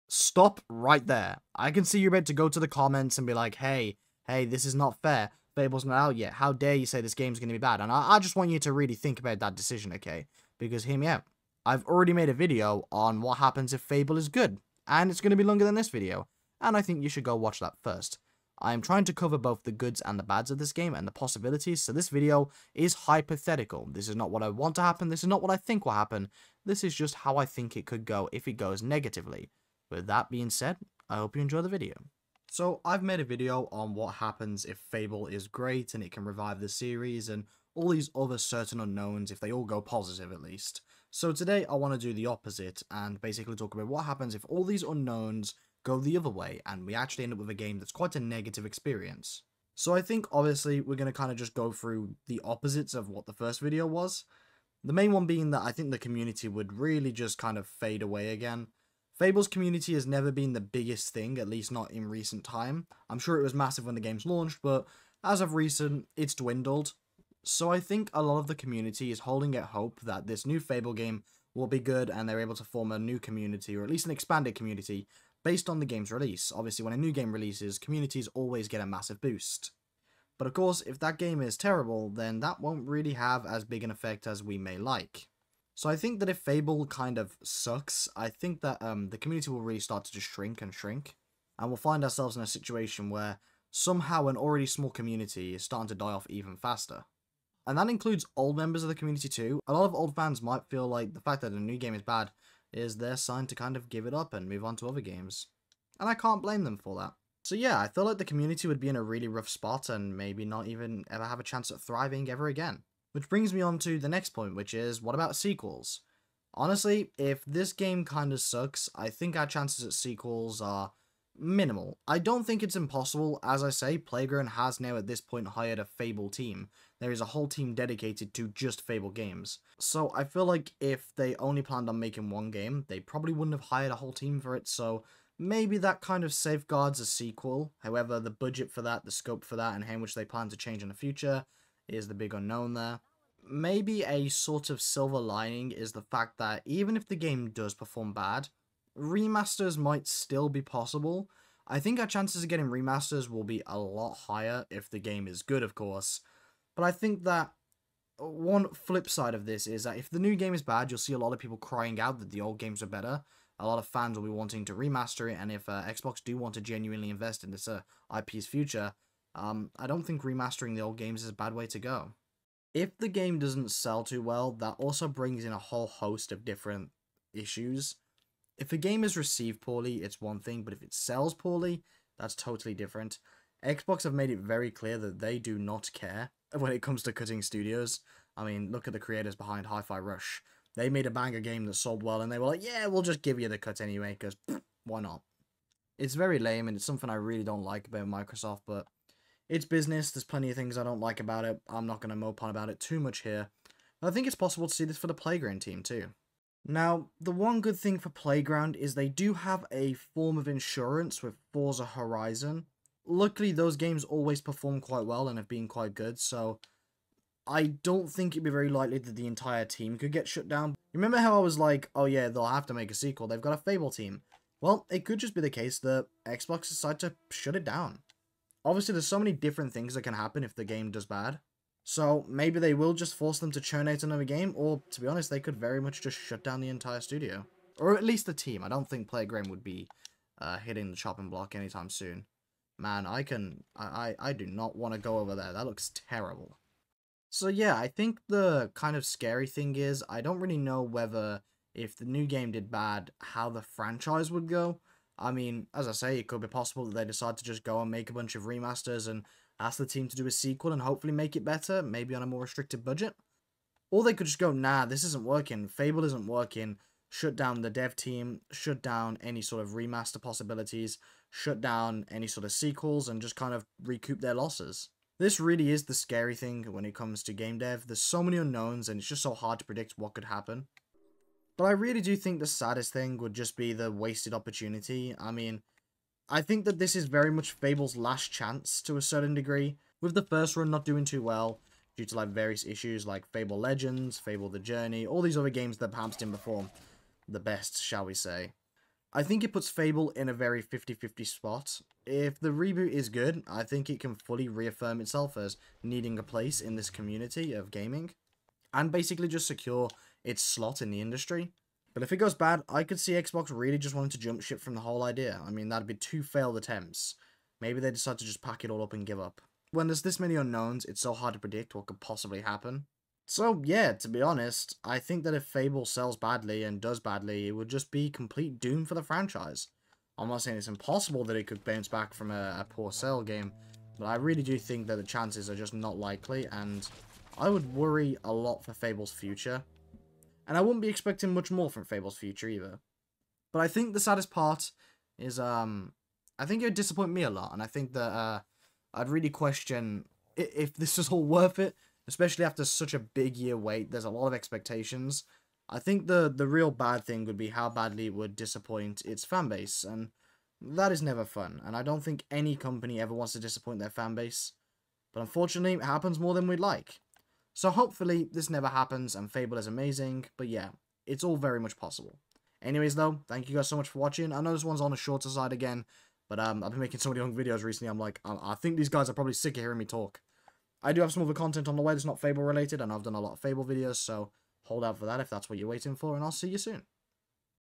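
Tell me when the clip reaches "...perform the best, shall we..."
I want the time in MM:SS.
04:56.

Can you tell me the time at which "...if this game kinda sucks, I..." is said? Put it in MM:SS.
01:57.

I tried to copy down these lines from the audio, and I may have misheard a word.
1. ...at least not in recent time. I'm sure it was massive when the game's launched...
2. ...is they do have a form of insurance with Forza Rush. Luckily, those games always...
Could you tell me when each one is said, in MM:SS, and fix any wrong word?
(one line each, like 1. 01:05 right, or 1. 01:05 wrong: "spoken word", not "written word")
1. 01:01 right
2. 03:28 wrong: "Horizon", not "Rush".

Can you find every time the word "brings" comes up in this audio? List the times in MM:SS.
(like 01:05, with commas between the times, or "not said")
01:53, 02:55.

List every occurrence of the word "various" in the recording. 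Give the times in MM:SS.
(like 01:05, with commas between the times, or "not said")
04:52.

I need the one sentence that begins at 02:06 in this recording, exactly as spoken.
There is a whole team dedicated to just Fable games.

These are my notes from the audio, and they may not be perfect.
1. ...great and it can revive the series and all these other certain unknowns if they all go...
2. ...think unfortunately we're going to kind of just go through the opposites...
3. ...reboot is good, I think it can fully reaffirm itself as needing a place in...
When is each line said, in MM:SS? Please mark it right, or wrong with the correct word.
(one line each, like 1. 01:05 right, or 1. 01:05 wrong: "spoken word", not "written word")
1. 00:35 right
2. 00:50 wrong: "obviously", not "unfortunately"
3. 05:02 right.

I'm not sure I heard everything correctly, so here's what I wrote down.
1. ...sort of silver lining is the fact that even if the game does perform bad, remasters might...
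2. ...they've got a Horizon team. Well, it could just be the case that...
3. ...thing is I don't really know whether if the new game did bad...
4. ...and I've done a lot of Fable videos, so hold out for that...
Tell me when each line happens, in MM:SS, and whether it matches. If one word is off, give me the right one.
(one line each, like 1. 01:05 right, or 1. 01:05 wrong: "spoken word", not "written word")
1. 02:24 right
2. 03:43 wrong: "Fable", not "Horizon"
3. 04:09 right
4. 06:22 right.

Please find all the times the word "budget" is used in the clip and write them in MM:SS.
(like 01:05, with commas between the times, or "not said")
02:18, 04:22.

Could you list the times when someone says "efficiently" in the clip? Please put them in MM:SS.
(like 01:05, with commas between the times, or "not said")
not said.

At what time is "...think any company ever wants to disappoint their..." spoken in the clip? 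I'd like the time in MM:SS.
06:02.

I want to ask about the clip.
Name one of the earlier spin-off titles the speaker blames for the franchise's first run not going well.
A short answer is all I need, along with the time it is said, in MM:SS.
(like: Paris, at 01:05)
Fable Legends, at 04:53.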